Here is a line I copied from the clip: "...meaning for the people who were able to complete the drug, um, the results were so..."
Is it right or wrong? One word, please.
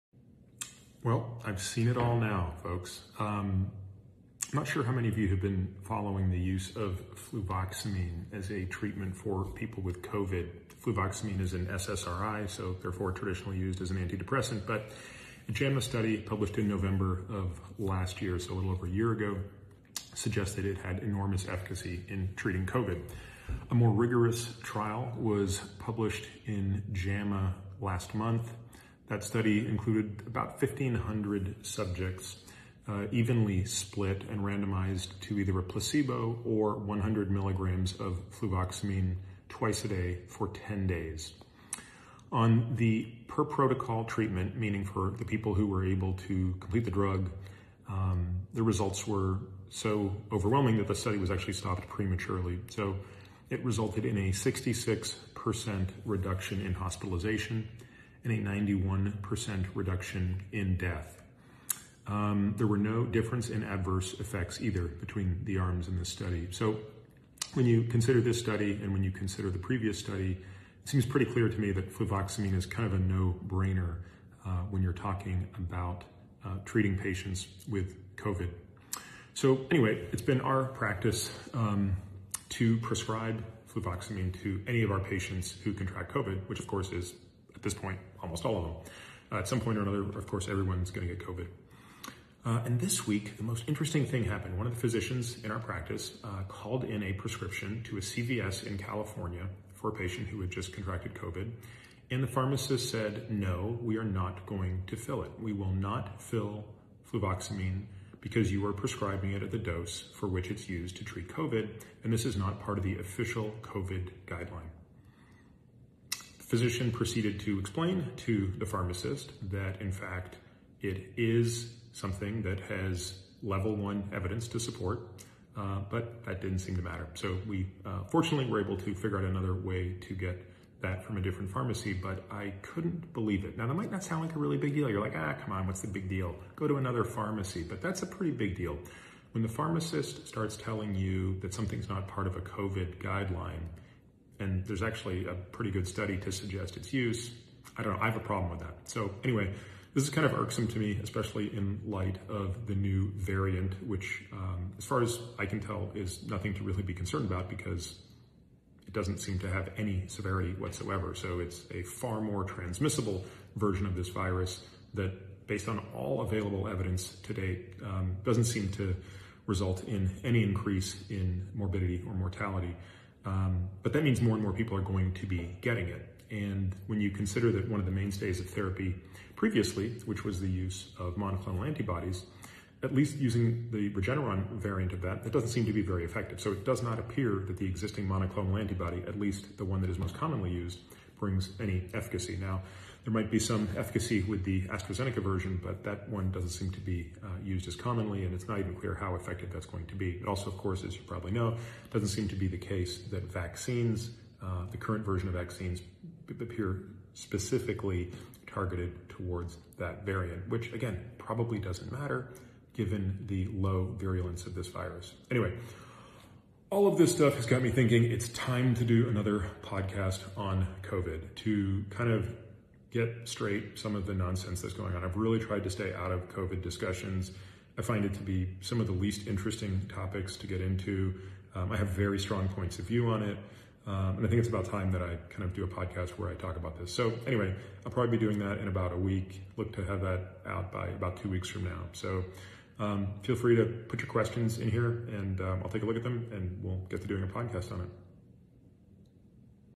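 right.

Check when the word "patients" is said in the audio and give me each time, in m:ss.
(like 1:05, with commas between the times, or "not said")
1:16, 1:24, 1:39.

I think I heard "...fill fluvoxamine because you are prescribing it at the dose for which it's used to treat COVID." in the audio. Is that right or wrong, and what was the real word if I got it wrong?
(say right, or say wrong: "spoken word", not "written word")
right.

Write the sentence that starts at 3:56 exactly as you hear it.
So, anyway, I'll probably be doing that in about a week.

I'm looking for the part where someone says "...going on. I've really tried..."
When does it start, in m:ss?
3:44.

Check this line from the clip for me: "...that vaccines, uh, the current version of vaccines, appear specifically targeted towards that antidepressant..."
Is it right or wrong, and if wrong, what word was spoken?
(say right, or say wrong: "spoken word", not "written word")
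wrong: "variant", not "antidepressant".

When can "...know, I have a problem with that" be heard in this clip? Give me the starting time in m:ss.
2:27.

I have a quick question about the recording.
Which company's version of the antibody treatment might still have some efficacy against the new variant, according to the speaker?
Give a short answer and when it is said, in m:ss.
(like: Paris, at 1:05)
AstraZeneca, at 3:14.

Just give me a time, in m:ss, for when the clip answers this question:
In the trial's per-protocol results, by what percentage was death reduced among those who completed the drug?
0:58.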